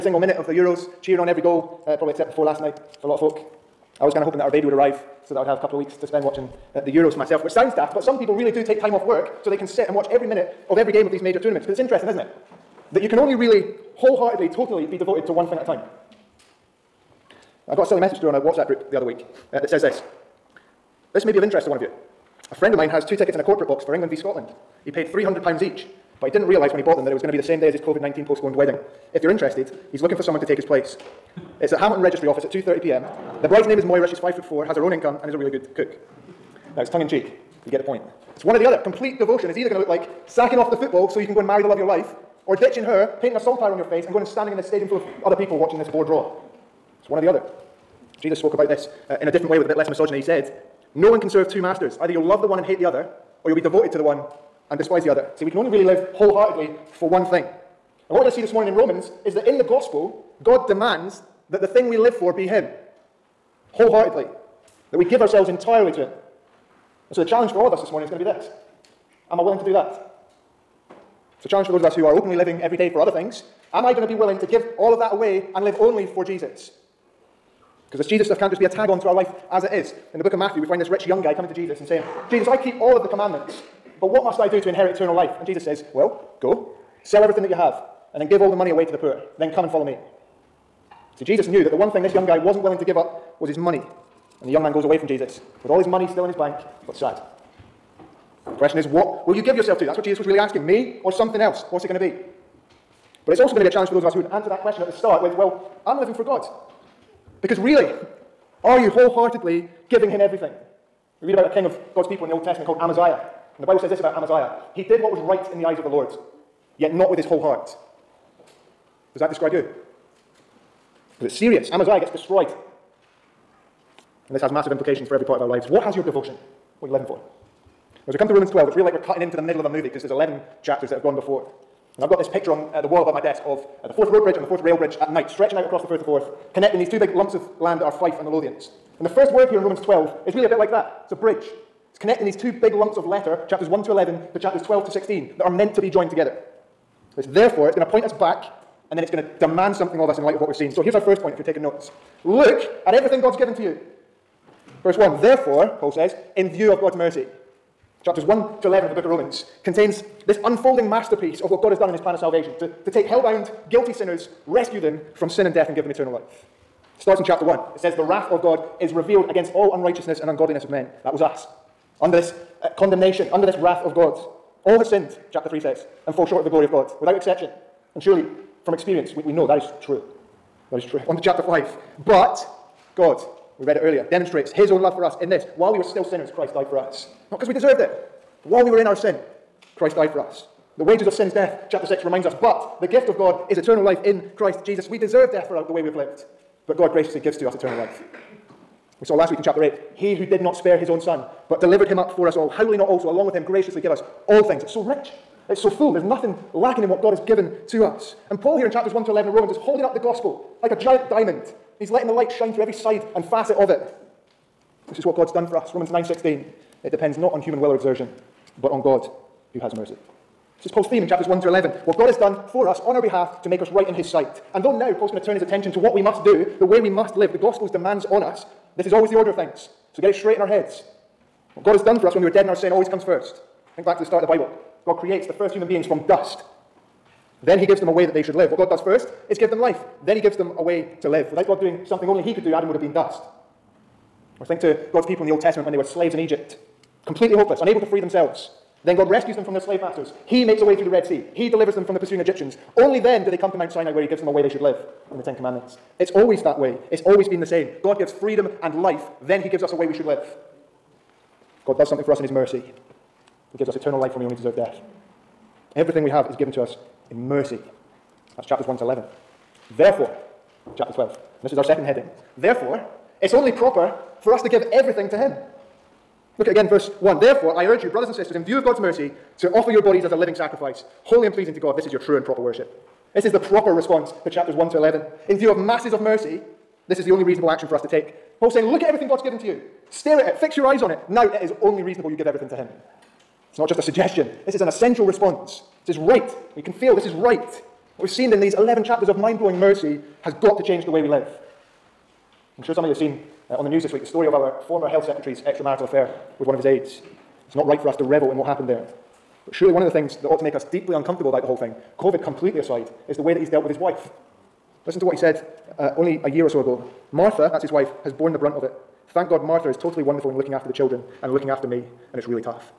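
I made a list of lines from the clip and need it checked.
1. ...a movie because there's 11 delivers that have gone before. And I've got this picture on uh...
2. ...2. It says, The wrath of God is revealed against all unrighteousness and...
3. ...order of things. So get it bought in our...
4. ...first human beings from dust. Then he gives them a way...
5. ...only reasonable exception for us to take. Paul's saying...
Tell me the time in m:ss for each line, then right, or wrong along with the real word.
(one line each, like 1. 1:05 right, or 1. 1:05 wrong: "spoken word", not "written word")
1. 2:09 wrong: "chapters", not "delivers"
2. 2:47 wrong: "1", not "2"
3. 3:49 wrong: "straight", not "bought"
4. 3:55 right
5. 4:47 wrong: "action", not "exception".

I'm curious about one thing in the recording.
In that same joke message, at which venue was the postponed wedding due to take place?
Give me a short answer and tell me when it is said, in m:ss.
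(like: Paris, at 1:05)
Hamilton Registry Office, at 0:31.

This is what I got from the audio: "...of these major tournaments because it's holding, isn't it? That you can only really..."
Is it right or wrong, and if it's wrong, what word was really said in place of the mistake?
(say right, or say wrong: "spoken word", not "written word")
wrong: "interesting", not "holding".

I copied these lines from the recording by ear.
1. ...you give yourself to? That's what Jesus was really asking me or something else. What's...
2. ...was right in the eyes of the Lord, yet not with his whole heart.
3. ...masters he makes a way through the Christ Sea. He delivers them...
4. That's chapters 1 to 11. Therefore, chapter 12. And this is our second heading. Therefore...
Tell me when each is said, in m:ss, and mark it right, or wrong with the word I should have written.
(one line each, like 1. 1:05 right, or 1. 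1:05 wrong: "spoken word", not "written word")
1. 1:39 right
2. 1:55 right
3. 4:09 wrong: "Red", not "Christ"
4. 4:28 right.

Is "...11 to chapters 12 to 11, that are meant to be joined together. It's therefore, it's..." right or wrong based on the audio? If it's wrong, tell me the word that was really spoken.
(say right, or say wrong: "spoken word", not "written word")
wrong: "16", not "11".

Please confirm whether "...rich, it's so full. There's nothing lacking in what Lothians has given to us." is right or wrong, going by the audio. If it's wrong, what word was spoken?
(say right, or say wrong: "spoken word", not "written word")
wrong: "God", not "Lothians".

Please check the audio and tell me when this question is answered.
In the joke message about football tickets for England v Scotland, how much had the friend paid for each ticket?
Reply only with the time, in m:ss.
0:25.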